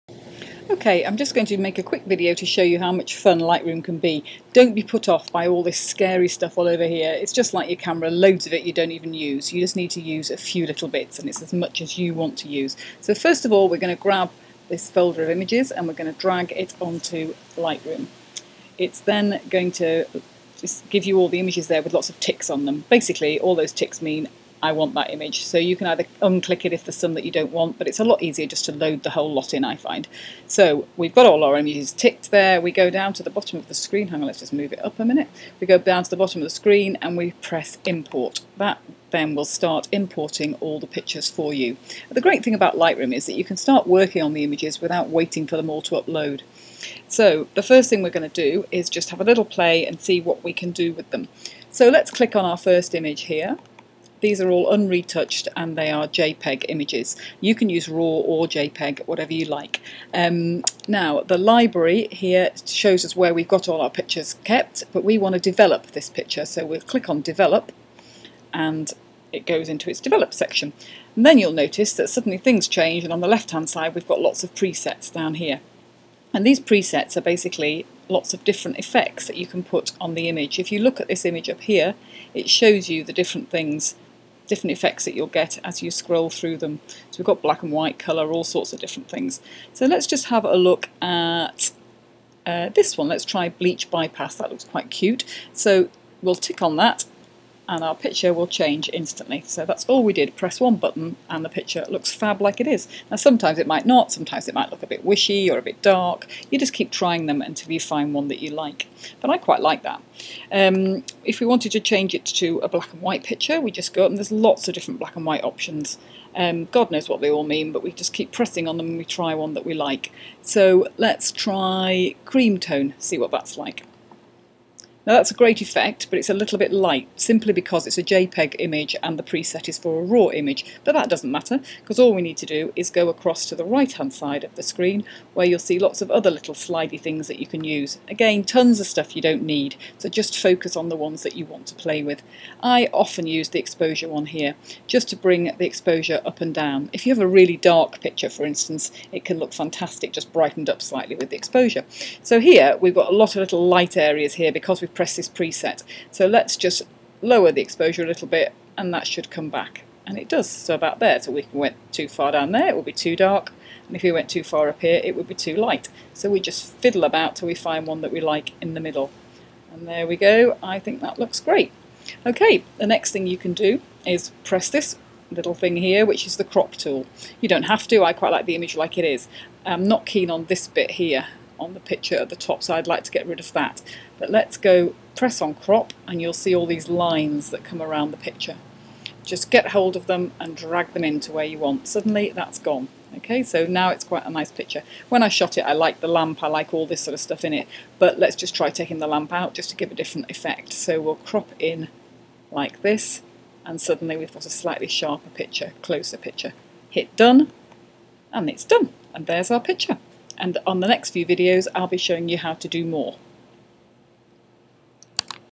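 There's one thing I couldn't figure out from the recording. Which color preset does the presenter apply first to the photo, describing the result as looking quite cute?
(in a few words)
Bleach bypass.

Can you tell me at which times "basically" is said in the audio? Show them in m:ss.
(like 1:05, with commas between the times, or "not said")
0:22, 1:17.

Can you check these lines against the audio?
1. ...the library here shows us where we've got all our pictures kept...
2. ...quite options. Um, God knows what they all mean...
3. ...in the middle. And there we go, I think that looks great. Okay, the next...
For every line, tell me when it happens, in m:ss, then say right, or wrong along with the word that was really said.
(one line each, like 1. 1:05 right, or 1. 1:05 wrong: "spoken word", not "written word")
1. 1:01 right
2. 1:55 wrong: "white", not "quite"
3. 2:48 right.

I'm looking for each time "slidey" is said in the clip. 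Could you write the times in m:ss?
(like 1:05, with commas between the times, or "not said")
2:16.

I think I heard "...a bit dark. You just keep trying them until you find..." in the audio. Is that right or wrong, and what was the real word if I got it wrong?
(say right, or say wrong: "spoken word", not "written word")
right.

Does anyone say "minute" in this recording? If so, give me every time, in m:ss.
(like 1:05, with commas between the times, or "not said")
0:35.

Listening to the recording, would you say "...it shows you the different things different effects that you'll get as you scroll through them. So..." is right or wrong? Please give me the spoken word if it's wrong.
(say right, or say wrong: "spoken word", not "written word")
right.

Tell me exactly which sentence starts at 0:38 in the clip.
That then will start importing all the pictures for you.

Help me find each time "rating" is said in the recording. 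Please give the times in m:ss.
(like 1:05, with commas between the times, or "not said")
not said.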